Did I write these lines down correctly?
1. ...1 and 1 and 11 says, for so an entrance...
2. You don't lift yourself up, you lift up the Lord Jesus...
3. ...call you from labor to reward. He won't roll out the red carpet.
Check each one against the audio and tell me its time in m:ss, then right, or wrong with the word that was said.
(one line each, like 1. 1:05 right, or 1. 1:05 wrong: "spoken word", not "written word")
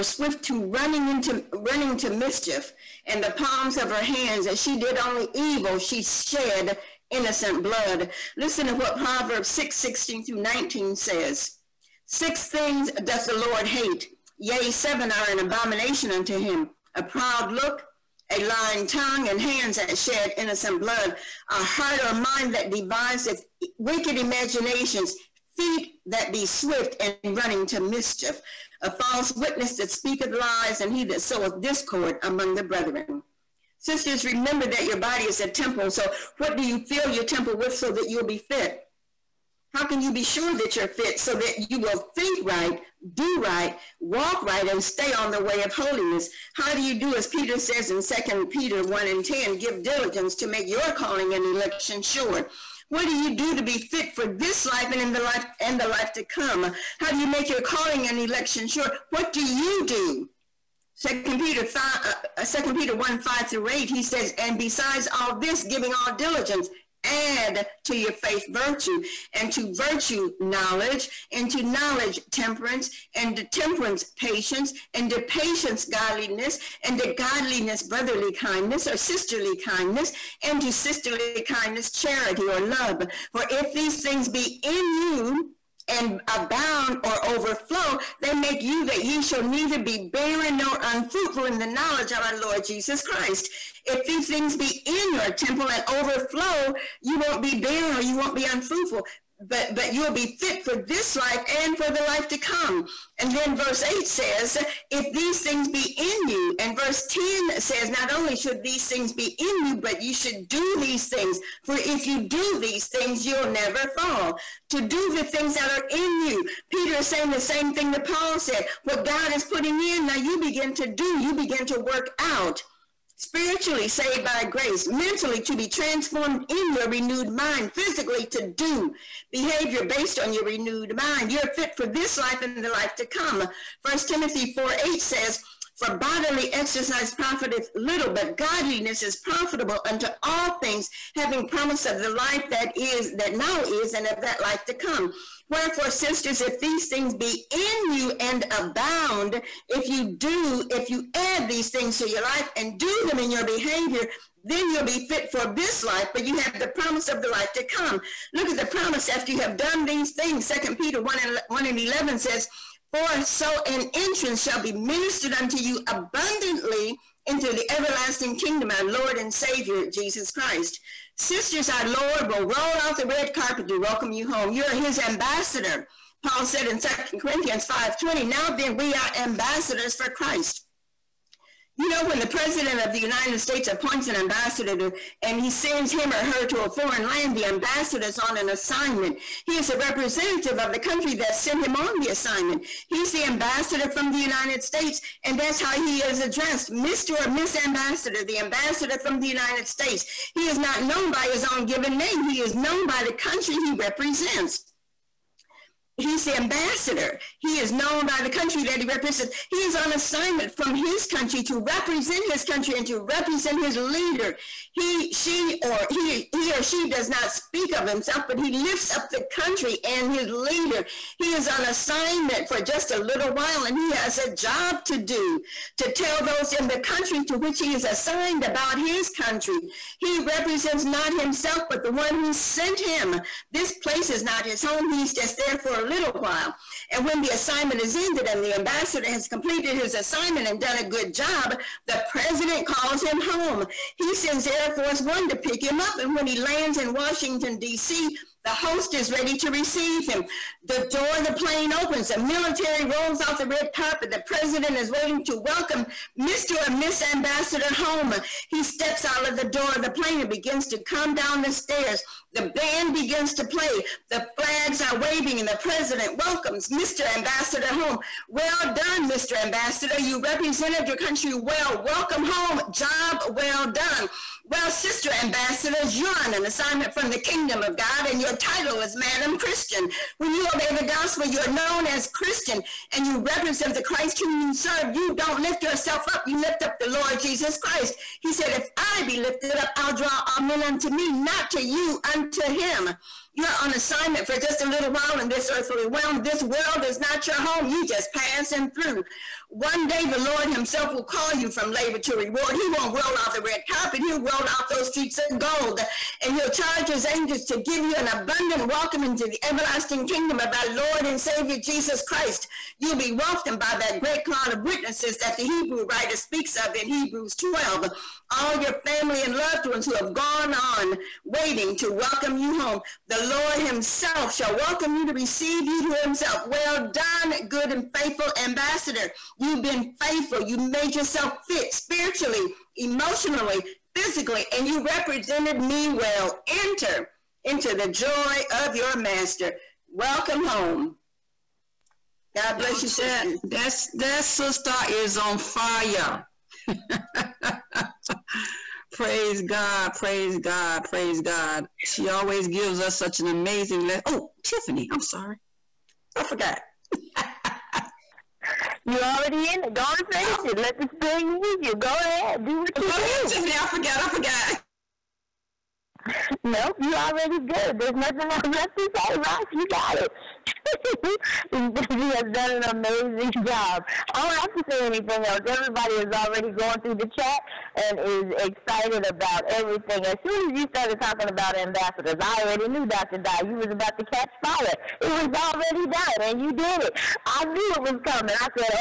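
1. 2:41 right
2. 4:44 right
3. 5:01 right.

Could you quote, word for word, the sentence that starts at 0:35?
So, what do you fill your temple with so that you'll be fit?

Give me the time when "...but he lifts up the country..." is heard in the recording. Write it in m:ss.
3:38.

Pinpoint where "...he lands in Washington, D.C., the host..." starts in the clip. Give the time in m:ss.
4:06.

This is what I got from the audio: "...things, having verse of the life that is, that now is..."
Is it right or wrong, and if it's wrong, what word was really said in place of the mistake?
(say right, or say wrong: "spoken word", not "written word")
wrong: "promise", not "verse".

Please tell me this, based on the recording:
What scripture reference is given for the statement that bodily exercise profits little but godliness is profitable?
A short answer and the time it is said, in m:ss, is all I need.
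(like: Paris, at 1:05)
First Timothy 4:8, at 2:13.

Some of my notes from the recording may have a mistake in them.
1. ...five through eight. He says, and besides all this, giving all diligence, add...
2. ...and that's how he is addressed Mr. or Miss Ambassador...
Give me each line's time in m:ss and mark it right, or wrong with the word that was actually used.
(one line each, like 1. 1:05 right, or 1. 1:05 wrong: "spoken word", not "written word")
1. 1:03 right
2. 3:15 right.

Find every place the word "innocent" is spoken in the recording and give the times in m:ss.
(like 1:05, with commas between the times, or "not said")
0:07, 0:20.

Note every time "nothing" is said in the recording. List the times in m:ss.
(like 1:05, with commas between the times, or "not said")
6:07.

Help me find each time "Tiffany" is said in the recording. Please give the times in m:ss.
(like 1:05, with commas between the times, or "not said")
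5:54, 6:03.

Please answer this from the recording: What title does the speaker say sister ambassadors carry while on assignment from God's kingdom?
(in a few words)
Madam Christian.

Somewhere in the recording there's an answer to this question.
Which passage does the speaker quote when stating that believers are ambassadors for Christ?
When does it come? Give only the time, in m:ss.
2:56.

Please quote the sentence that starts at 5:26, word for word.
Well done, good and faithful ambassador.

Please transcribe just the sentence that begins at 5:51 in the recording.
She always gives us such an amazing lesson.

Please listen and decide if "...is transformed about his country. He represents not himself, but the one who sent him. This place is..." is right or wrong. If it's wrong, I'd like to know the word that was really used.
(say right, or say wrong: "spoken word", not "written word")
wrong: "assigned", not "transformed".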